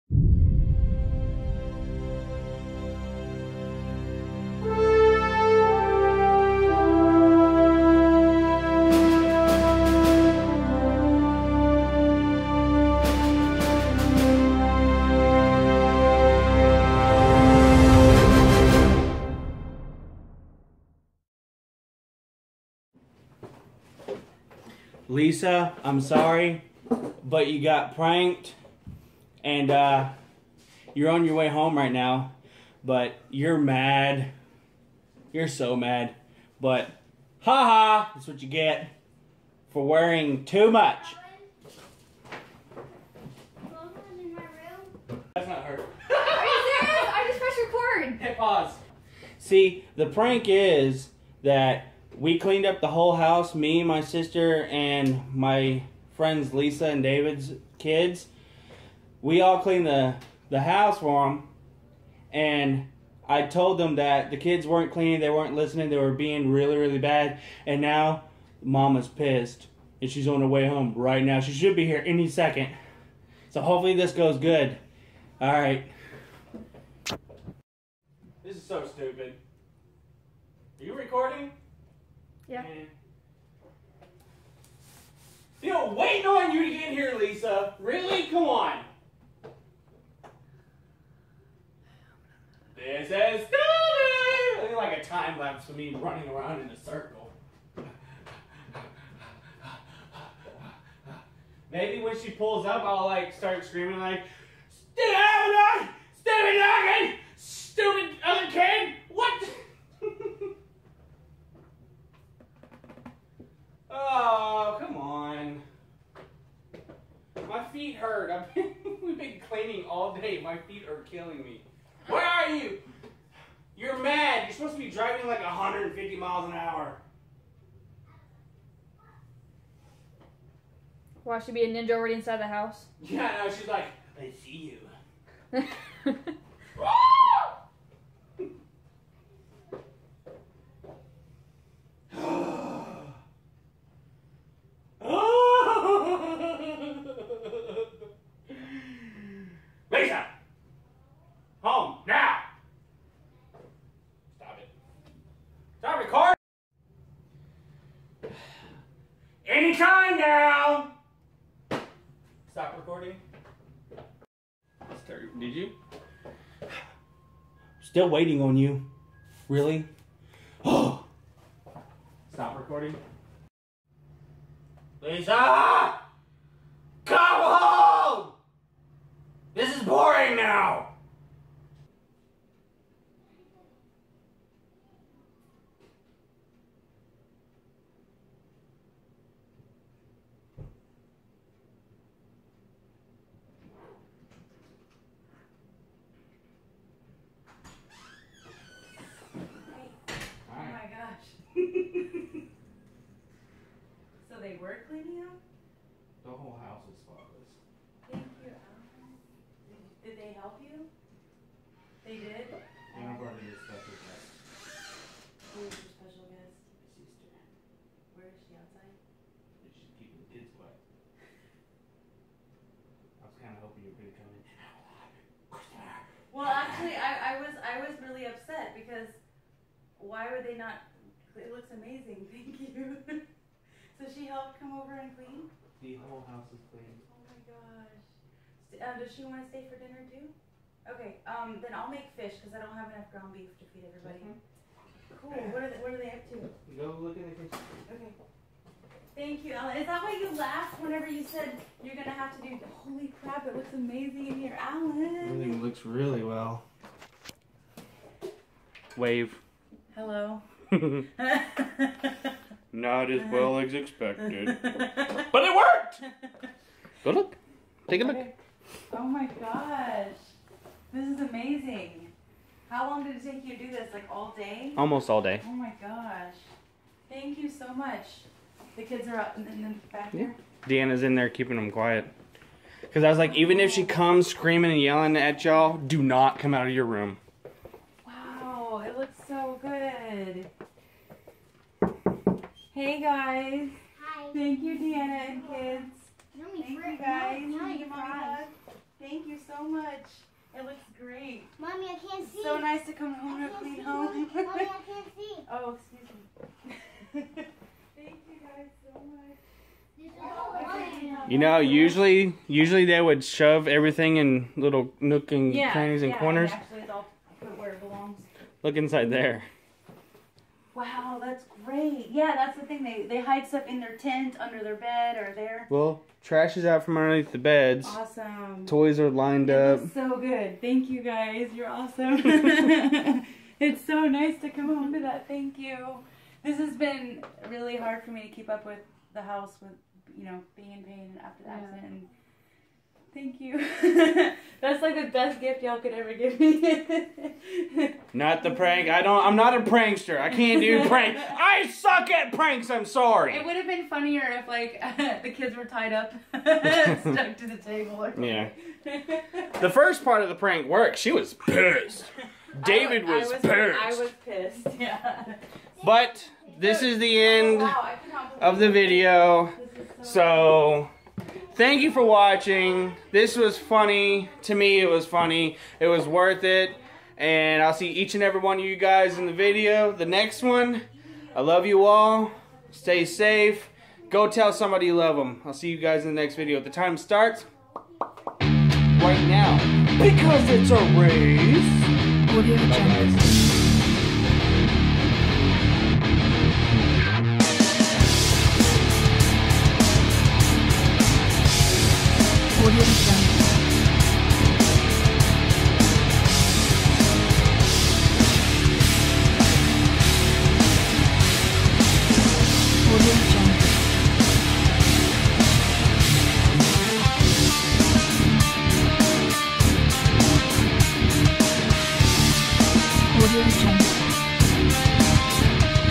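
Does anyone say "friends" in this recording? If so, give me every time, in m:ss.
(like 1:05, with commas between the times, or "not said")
0:56.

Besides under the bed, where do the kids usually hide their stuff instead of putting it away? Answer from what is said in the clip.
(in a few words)
Their tent.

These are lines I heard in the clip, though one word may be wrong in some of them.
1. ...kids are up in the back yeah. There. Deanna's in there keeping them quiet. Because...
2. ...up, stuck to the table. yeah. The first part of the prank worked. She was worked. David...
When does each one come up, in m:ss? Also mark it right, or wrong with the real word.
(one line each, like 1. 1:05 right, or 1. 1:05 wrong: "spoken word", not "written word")
1. 4:38 right
2. 5:55 wrong: "pissed", not "worked".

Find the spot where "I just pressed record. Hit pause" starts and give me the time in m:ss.
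0:47.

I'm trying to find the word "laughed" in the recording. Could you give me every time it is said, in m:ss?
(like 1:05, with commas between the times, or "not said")
4:10.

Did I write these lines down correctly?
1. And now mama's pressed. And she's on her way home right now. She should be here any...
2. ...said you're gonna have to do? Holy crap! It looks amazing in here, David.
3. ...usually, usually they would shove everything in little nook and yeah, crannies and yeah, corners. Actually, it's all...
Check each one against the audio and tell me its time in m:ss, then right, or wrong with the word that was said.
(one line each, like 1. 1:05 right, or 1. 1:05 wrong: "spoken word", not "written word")
1. 1:07 wrong: "pissed", not "pressed"
2. 4:11 wrong: "Allen", not "David"
3. 5:11 right.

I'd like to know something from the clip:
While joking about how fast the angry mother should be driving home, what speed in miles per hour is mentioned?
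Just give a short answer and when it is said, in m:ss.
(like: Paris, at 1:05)
150, at 2:05.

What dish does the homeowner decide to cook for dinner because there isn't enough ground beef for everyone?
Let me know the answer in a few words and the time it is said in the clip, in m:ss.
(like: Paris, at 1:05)
Fish, at 4:02.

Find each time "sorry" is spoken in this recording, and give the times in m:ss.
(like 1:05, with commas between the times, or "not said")
0:25, 5:52.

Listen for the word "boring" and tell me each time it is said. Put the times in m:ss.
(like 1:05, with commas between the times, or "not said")
not said.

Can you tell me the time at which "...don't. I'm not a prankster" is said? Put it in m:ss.
5:49.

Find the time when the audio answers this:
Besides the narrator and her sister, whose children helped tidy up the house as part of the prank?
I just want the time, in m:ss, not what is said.
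0:56.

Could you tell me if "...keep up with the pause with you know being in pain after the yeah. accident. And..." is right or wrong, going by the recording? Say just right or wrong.
wrong.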